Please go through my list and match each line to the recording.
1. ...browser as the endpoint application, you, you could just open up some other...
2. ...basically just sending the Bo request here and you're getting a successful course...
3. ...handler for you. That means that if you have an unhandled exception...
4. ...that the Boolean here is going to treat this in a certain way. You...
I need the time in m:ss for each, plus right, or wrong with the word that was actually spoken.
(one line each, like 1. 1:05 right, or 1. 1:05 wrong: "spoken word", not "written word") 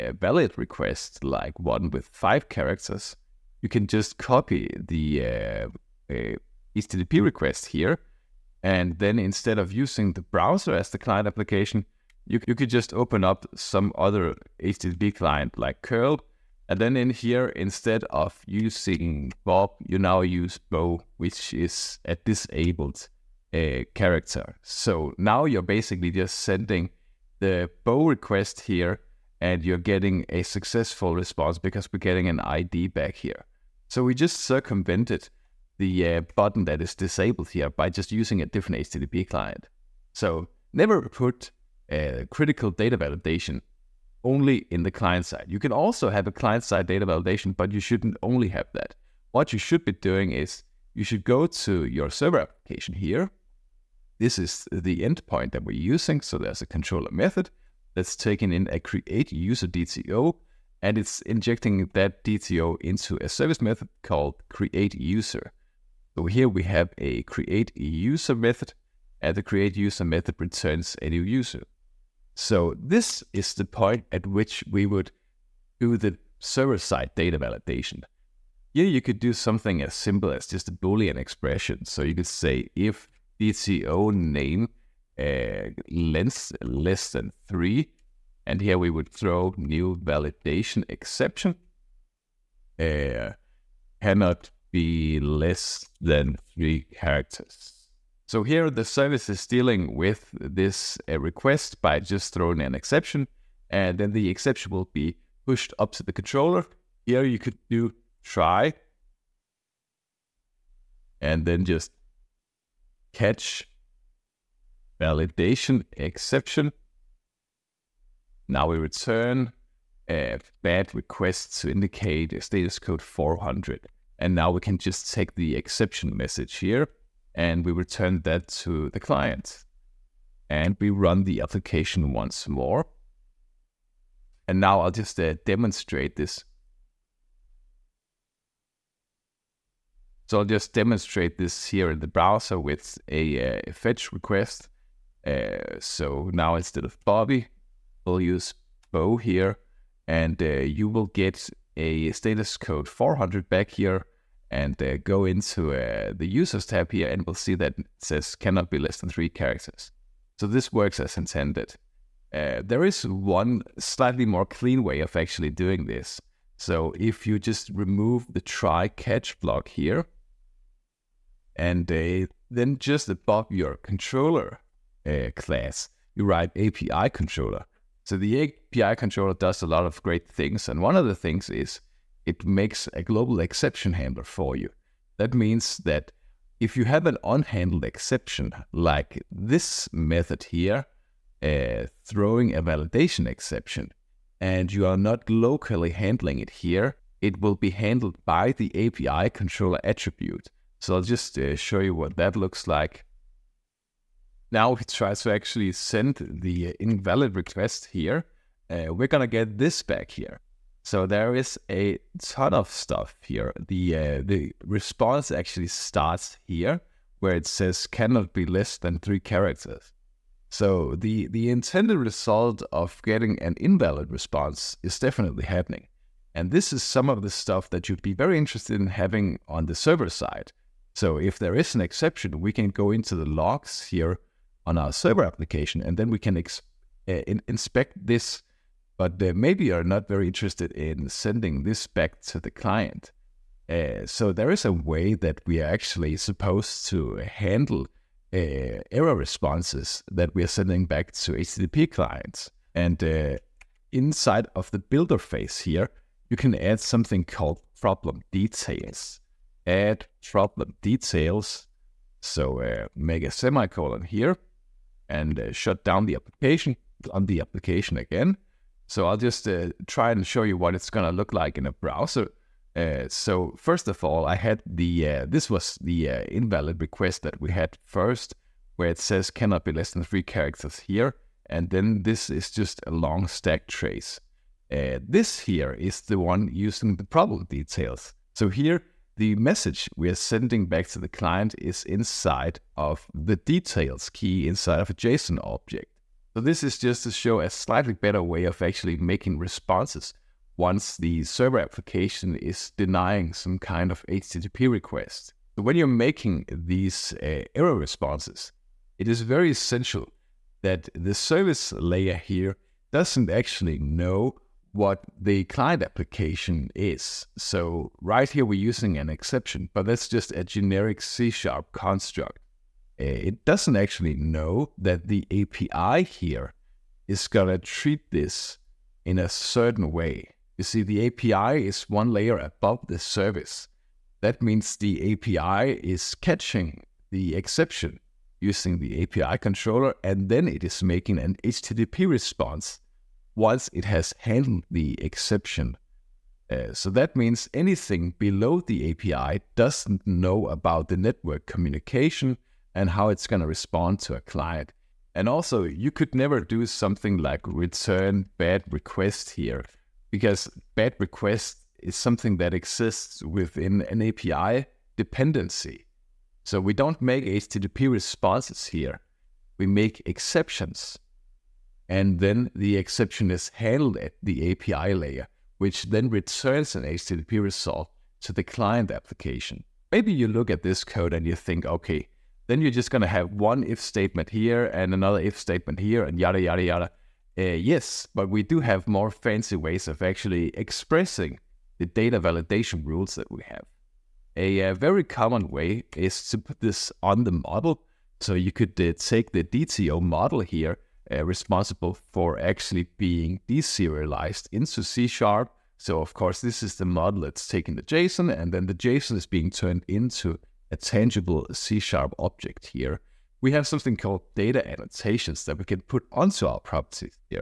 1. 0:10 wrong: "client", not "endpoint"
2. 0:25 wrong: "response", not "course"
3. 3:03 right
4. 5:24 wrong: "API", not "Boolean".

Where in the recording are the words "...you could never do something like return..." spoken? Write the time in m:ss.
5:55.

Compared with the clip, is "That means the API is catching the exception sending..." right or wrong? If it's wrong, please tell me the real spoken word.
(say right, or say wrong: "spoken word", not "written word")
wrong: "using", not "sending".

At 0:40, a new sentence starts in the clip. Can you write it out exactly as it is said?
So never put a uh, critical data validation only in the client side.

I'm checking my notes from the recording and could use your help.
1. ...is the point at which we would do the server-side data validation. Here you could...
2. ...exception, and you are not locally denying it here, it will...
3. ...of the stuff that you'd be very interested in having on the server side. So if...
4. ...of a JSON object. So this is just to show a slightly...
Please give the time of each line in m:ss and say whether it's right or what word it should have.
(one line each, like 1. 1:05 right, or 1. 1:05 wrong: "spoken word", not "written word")
1. 1:13 right
2. 3:13 wrong: "handling", not "denying"
3. 3:47 right
4. 4:54 right.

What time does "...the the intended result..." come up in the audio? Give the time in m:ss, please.
3:40.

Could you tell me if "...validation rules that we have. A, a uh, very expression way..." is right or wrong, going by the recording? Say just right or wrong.
wrong.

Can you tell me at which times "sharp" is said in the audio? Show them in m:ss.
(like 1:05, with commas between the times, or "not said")
5:21, 6:45, 6:51.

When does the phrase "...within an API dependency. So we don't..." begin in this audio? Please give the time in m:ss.
6:03.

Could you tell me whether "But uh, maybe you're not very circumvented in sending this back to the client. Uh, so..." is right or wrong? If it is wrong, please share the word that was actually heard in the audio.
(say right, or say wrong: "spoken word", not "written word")
wrong: "interested", not "circumvented".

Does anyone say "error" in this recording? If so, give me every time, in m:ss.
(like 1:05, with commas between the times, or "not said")
4:08, 5:07.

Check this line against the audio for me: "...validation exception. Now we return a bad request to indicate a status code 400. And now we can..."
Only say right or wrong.
right.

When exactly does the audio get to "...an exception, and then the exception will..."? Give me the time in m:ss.
1:42.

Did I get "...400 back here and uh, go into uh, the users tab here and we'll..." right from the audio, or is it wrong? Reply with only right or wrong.
right.